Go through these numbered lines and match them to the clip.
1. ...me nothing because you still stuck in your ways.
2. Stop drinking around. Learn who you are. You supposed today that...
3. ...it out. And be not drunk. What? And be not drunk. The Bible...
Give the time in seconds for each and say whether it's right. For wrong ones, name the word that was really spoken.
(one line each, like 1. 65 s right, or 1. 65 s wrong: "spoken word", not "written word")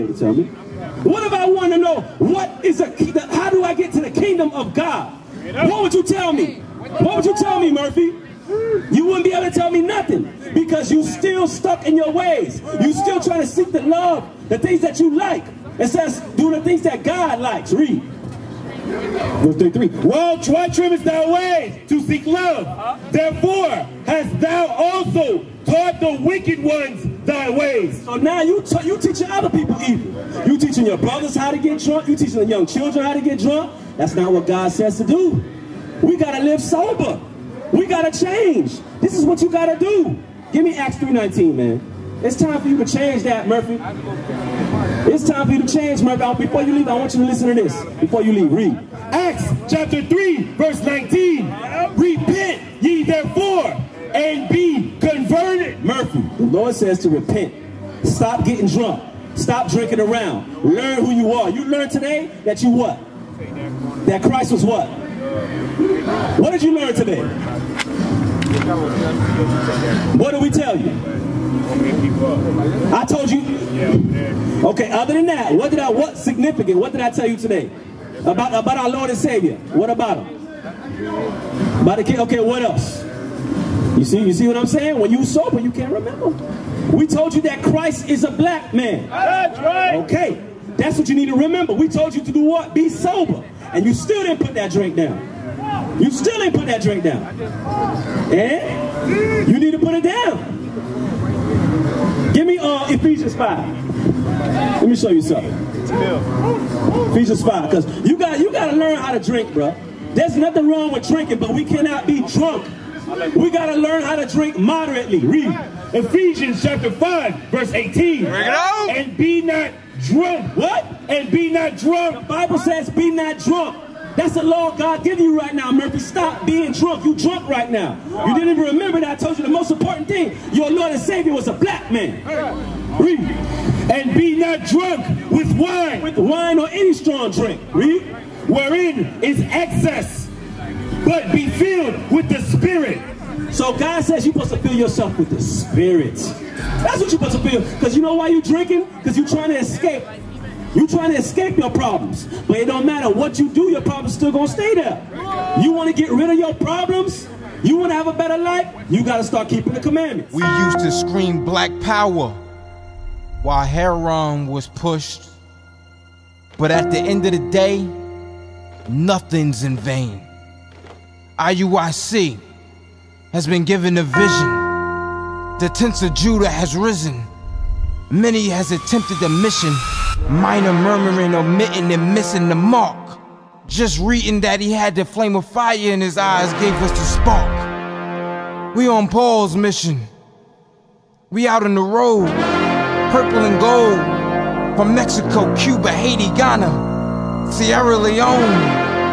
1. 9 s right
2. 59 s wrong: "learned", not "supposed"
3. 118 s right.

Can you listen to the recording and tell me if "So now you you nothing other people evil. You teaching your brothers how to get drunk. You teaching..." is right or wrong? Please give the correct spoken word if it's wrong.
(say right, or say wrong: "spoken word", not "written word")
wrong: "teaching", not "nothing".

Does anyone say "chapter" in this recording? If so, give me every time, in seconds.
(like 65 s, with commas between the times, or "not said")
49 s, 116 s.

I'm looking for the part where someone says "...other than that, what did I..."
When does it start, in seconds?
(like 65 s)
74 s.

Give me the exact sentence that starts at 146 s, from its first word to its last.
That's what you're supposed to feel.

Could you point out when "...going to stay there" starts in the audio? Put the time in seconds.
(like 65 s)
154 s.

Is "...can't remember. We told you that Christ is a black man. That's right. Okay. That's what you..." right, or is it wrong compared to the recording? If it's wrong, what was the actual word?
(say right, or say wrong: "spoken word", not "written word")
right.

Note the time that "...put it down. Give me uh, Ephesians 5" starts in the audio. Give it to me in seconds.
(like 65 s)
99 s.